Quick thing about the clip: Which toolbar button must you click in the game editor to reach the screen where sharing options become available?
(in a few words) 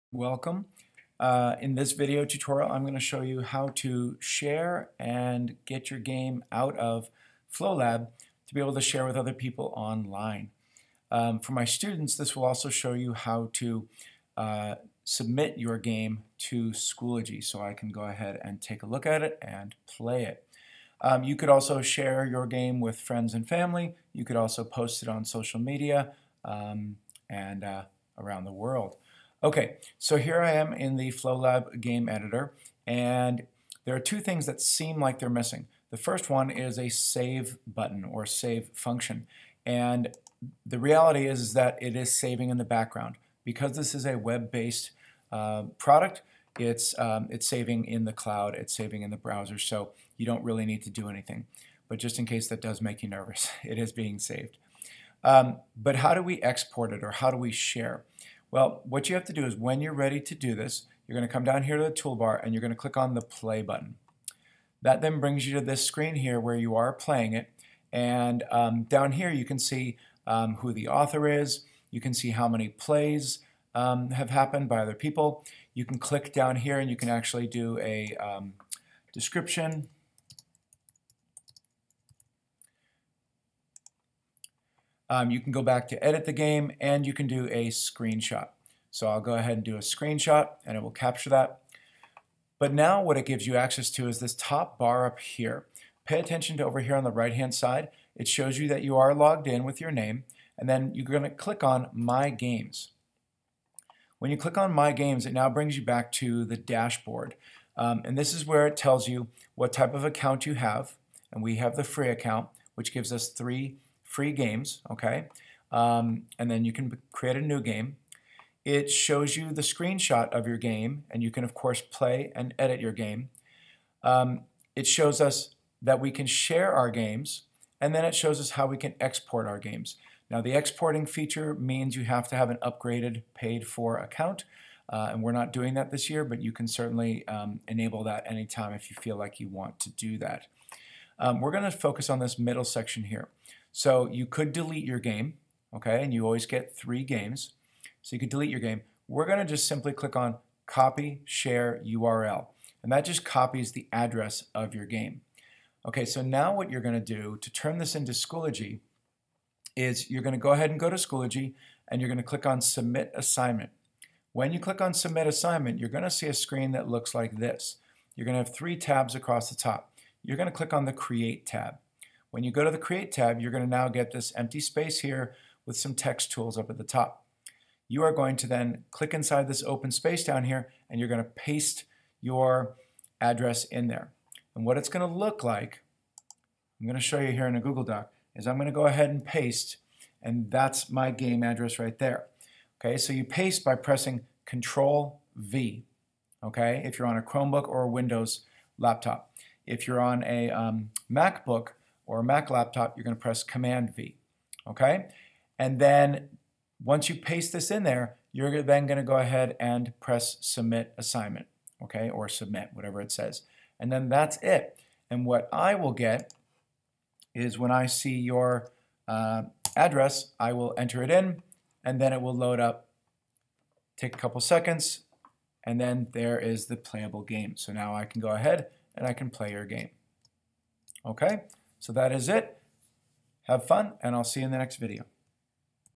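Play button.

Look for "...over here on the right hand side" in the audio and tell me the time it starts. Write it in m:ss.
1:36.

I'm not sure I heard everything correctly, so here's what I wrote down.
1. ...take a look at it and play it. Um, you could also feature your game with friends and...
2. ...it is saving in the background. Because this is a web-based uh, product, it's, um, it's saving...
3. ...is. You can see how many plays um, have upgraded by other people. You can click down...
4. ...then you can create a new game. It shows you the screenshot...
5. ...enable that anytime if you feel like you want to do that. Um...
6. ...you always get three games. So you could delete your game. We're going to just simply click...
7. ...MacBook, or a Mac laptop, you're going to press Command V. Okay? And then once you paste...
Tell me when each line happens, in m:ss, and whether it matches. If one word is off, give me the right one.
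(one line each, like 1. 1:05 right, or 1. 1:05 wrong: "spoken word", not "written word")
1. 0:18 wrong: "share", not "feature"
2. 0:41 right
3. 1:11 wrong: "happened", not "upgraded"
4. 1:56 right
5. 2:17 right
6. 2:26 right
7. 3:21 right.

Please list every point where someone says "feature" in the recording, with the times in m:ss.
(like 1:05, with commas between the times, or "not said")
2:11.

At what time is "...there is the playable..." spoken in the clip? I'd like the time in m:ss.
3:46.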